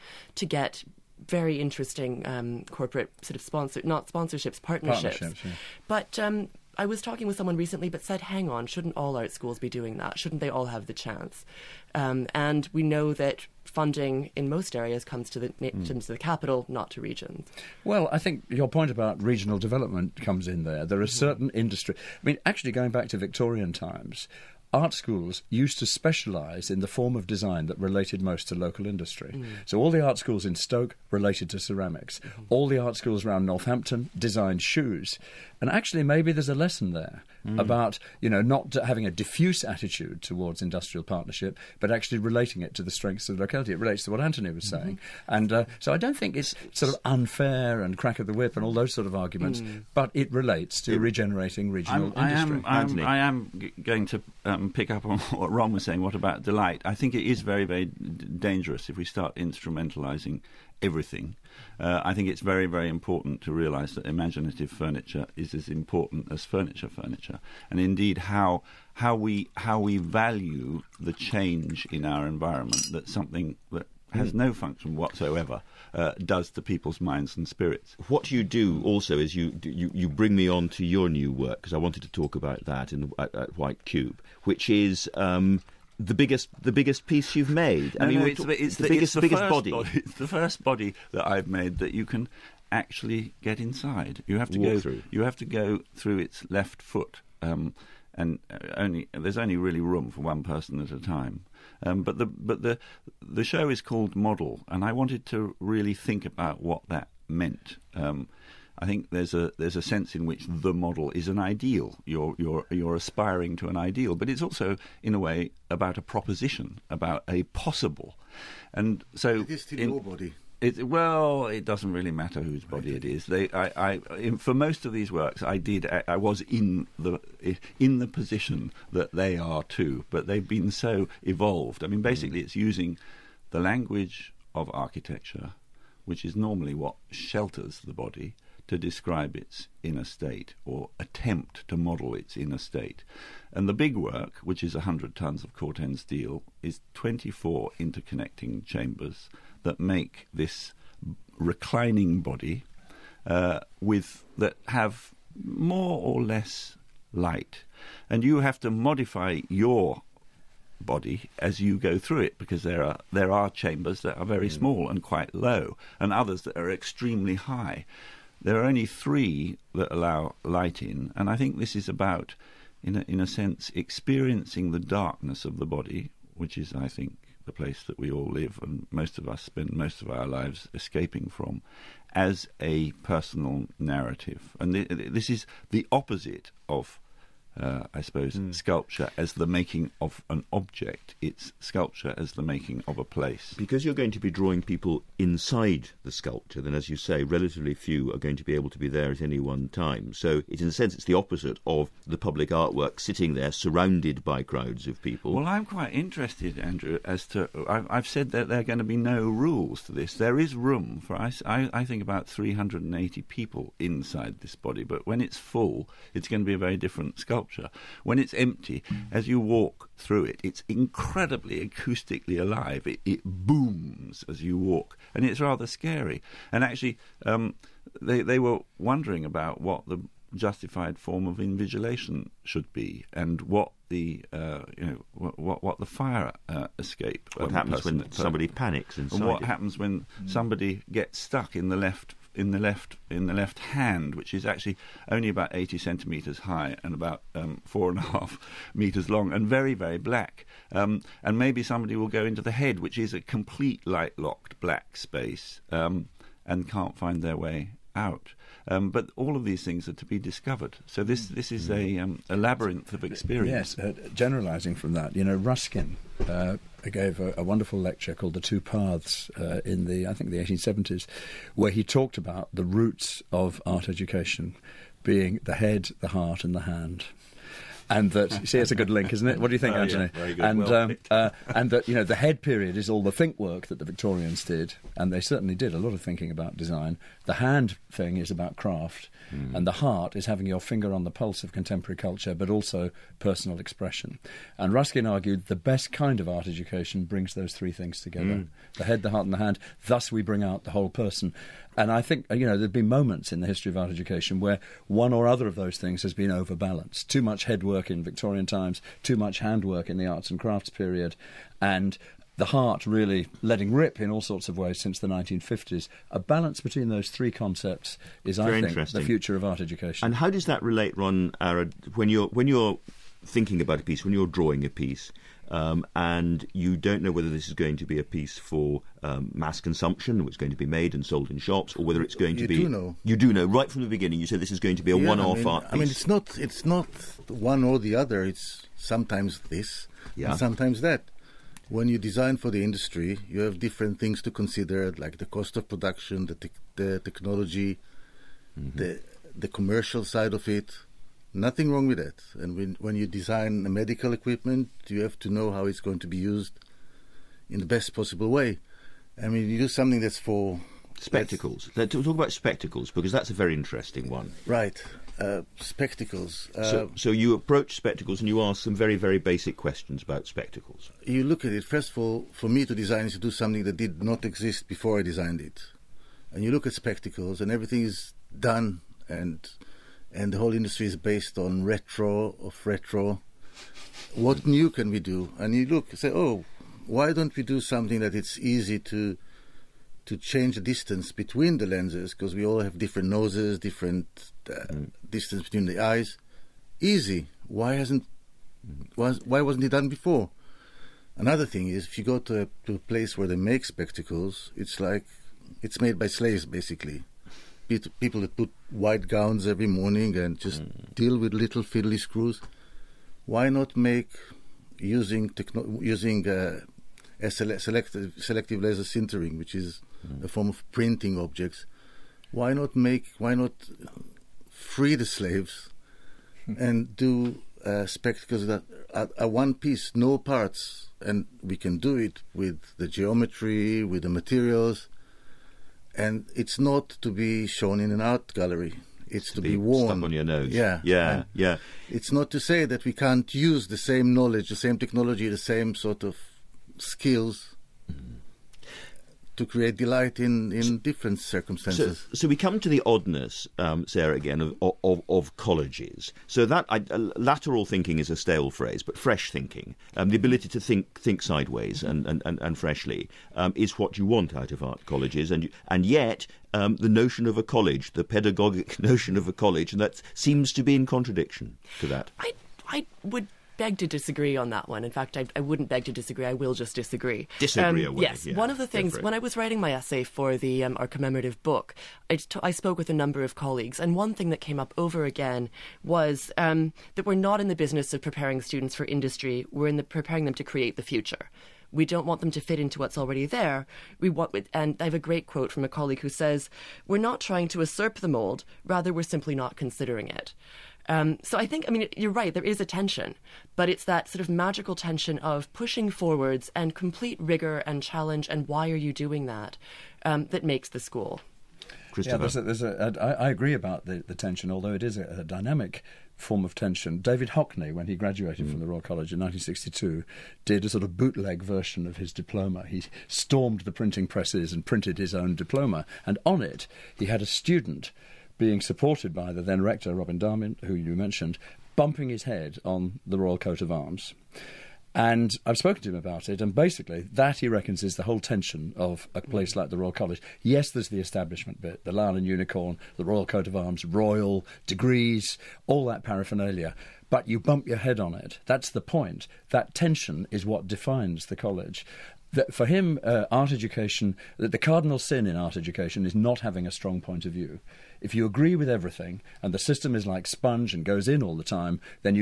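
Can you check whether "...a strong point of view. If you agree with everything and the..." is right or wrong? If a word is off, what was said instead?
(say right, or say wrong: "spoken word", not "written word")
right.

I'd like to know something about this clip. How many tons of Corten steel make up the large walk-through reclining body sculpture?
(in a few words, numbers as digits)
100.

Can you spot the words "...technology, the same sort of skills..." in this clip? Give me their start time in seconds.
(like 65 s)
444 s.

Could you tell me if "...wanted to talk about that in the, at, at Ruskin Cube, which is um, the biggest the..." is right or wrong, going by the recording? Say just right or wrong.
wrong.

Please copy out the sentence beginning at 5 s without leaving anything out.
But um, I was talking with someone recently, but said, hang on, shouldn't all art schools be doing that?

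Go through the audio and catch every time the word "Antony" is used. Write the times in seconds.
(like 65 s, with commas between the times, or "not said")
44 s, 279 s.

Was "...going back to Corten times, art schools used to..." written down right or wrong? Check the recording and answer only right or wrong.
wrong.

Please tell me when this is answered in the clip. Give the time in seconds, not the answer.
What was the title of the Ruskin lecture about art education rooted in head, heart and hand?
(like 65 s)
268 s.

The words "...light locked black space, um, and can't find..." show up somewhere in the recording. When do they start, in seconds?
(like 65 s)
253 s.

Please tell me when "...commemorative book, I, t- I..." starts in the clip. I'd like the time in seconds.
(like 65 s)
480 s.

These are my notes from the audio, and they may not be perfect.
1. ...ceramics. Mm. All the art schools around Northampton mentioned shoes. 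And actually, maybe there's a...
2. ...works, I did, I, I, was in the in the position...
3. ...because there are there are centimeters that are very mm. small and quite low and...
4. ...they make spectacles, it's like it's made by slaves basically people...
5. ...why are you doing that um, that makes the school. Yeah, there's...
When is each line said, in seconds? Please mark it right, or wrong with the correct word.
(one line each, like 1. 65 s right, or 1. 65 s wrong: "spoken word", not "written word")
1. 31 s wrong: "designed", not "mentioned"
2. 125 s right
3. 162 s wrong: "chambers", not "centimeters"
4. 403 s right
5. 508 s right.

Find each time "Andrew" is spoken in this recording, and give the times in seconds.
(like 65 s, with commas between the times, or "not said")
206 s.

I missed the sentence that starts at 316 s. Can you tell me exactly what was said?
A balance between those three concepts is, Very I think, the future of art education.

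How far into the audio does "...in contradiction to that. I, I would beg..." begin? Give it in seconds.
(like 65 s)
470 s.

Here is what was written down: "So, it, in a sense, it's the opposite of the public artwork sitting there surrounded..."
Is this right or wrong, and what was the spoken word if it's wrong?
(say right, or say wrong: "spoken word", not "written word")
right.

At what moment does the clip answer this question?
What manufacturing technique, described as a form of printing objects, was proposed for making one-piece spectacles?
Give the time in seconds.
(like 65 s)
418 s.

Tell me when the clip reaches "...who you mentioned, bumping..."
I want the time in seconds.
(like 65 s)
530 s.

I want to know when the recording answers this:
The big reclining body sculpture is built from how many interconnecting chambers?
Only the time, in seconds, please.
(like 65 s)
146 s.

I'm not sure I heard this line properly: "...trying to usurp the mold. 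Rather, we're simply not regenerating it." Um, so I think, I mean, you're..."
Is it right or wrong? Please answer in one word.
wrong.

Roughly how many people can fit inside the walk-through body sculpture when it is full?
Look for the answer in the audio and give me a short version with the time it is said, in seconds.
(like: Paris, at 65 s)
380, at 212 s.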